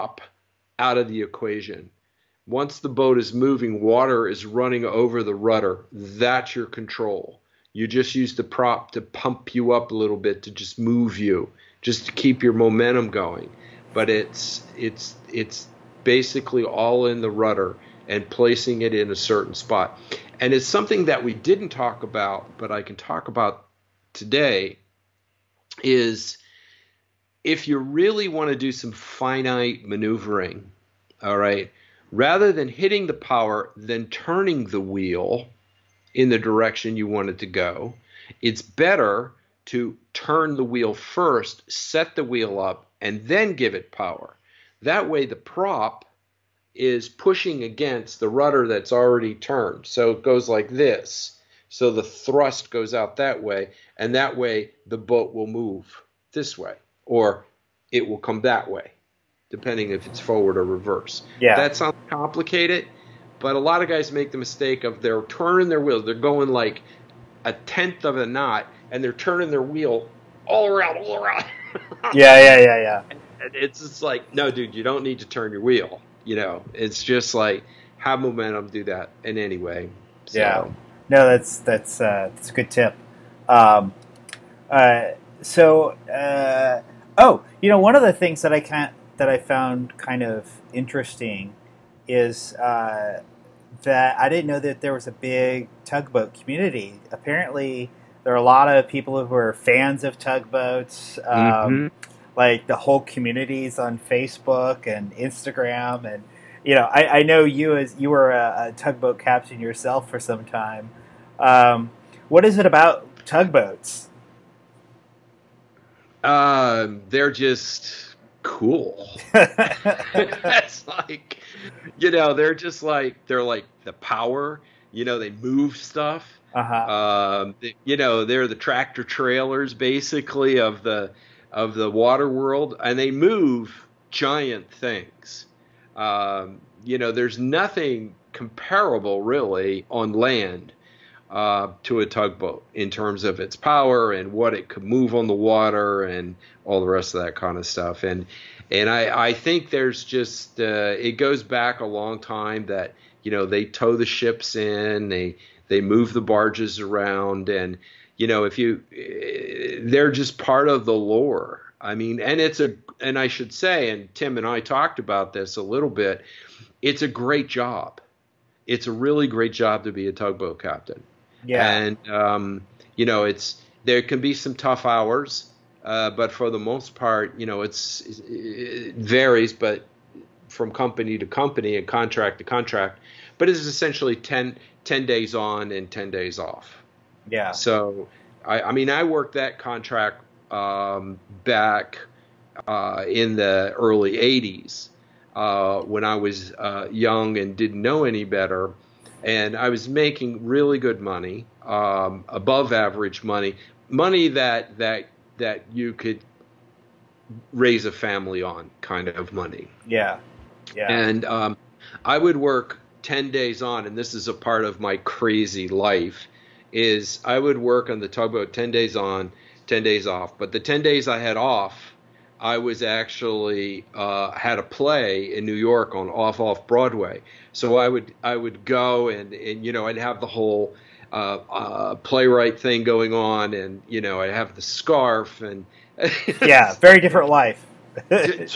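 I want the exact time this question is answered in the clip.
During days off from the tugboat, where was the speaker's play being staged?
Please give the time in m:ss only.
3:46.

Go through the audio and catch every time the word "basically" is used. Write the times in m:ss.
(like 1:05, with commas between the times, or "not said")
0:16, 2:09.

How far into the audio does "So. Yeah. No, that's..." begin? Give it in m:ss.
1:20.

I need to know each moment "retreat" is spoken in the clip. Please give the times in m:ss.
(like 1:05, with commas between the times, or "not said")
not said.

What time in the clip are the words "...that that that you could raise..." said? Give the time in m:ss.
3:24.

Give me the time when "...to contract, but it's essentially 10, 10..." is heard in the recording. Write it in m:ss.
3:02.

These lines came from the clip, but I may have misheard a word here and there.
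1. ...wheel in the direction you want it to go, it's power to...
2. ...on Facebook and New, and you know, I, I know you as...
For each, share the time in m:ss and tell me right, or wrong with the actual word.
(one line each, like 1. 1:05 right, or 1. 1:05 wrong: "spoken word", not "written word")
1. 0:34 wrong: "better", not "power"
2. 1:43 wrong: "Instagram", not "New".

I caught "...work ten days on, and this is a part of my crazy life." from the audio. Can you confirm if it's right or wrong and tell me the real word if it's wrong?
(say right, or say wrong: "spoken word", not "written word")
right.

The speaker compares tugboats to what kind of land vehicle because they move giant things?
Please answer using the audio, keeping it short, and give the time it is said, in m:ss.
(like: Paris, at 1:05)
Tractor trailers, at 2:08.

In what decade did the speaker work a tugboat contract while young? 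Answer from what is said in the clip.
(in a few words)
1980s.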